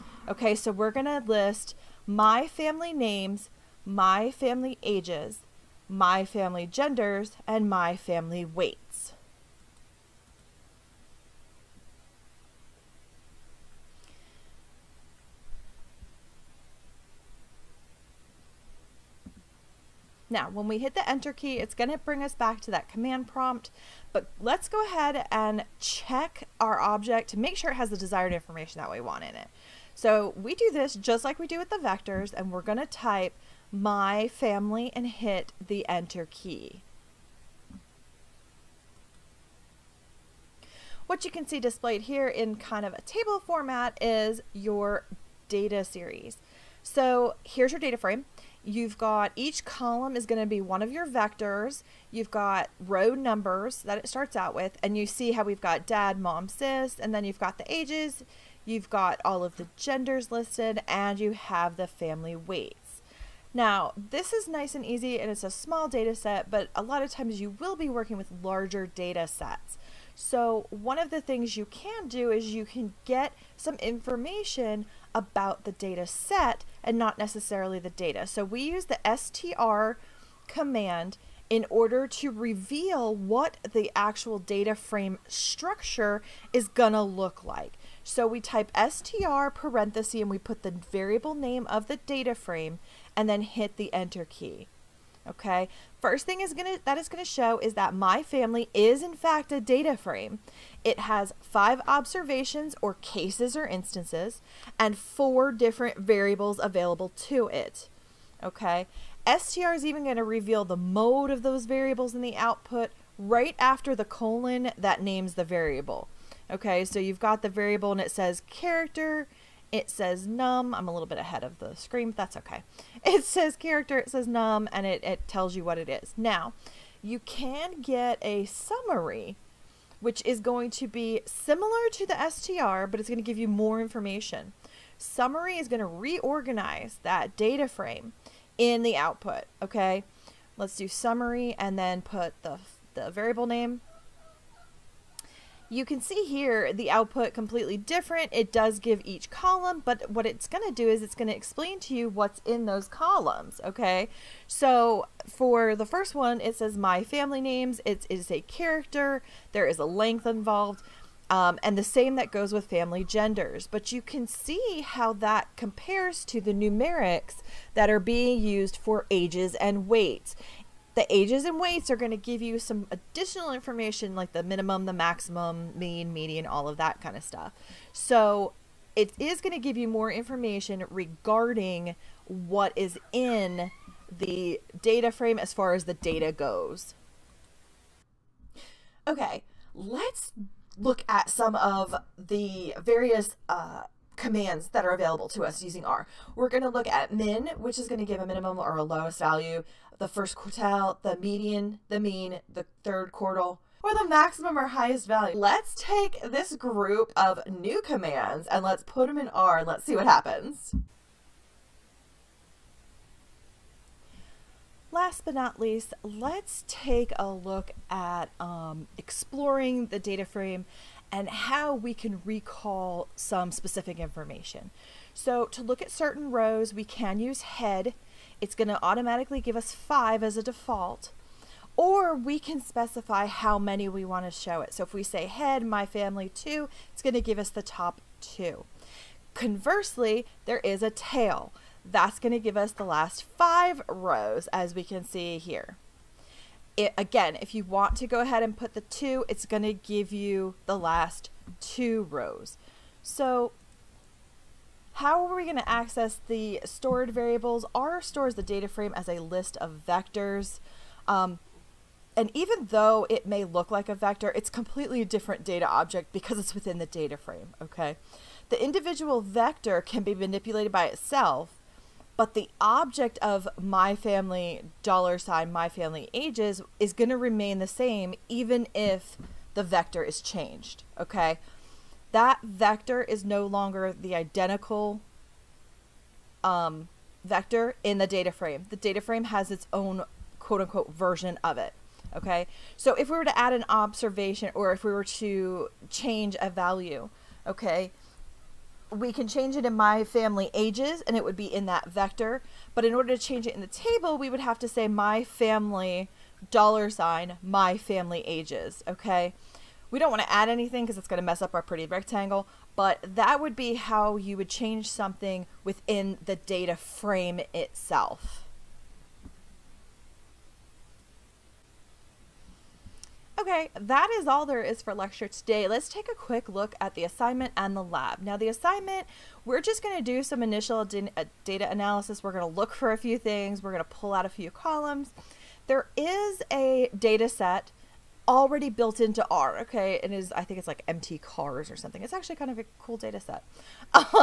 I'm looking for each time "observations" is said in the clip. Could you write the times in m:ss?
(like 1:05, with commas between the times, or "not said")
1:41, 4:53.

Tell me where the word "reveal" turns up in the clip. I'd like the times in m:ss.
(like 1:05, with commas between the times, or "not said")
1:22, 1:50.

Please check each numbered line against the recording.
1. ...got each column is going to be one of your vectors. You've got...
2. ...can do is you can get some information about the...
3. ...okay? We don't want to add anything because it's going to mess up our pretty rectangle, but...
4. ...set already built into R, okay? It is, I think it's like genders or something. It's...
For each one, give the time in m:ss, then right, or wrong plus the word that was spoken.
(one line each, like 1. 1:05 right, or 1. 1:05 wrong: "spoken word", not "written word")
1. 0:48 right
2. 1:11 right
3. 5:08 right
4. 5:37 wrong: "mtcars", not "genders".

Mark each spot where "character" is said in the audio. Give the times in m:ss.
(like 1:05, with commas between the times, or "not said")
1:58, 2:03, 2:38.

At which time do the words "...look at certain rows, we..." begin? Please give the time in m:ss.
3:45.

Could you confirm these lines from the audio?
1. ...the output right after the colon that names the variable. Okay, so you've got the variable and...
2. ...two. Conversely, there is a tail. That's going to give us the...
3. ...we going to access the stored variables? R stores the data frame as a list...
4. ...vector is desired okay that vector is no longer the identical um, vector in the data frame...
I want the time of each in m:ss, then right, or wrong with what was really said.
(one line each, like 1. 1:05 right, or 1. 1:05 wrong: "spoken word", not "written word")
1. 1:52 right
2. 3:58 right
3. 4:15 right
4. 4:39 wrong: "changed", not "desired".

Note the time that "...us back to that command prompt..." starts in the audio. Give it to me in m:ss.
0:22.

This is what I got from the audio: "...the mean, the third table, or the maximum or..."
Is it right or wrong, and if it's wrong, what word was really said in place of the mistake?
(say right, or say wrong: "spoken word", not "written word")
wrong: "quartile", not "table".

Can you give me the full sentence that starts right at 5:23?
Okay, that is all there is for lecture today.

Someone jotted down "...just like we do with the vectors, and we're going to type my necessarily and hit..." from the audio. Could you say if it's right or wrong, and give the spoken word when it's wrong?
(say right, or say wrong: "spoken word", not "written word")
wrong: "family", not "necessarily".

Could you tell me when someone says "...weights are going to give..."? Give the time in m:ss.
2:51.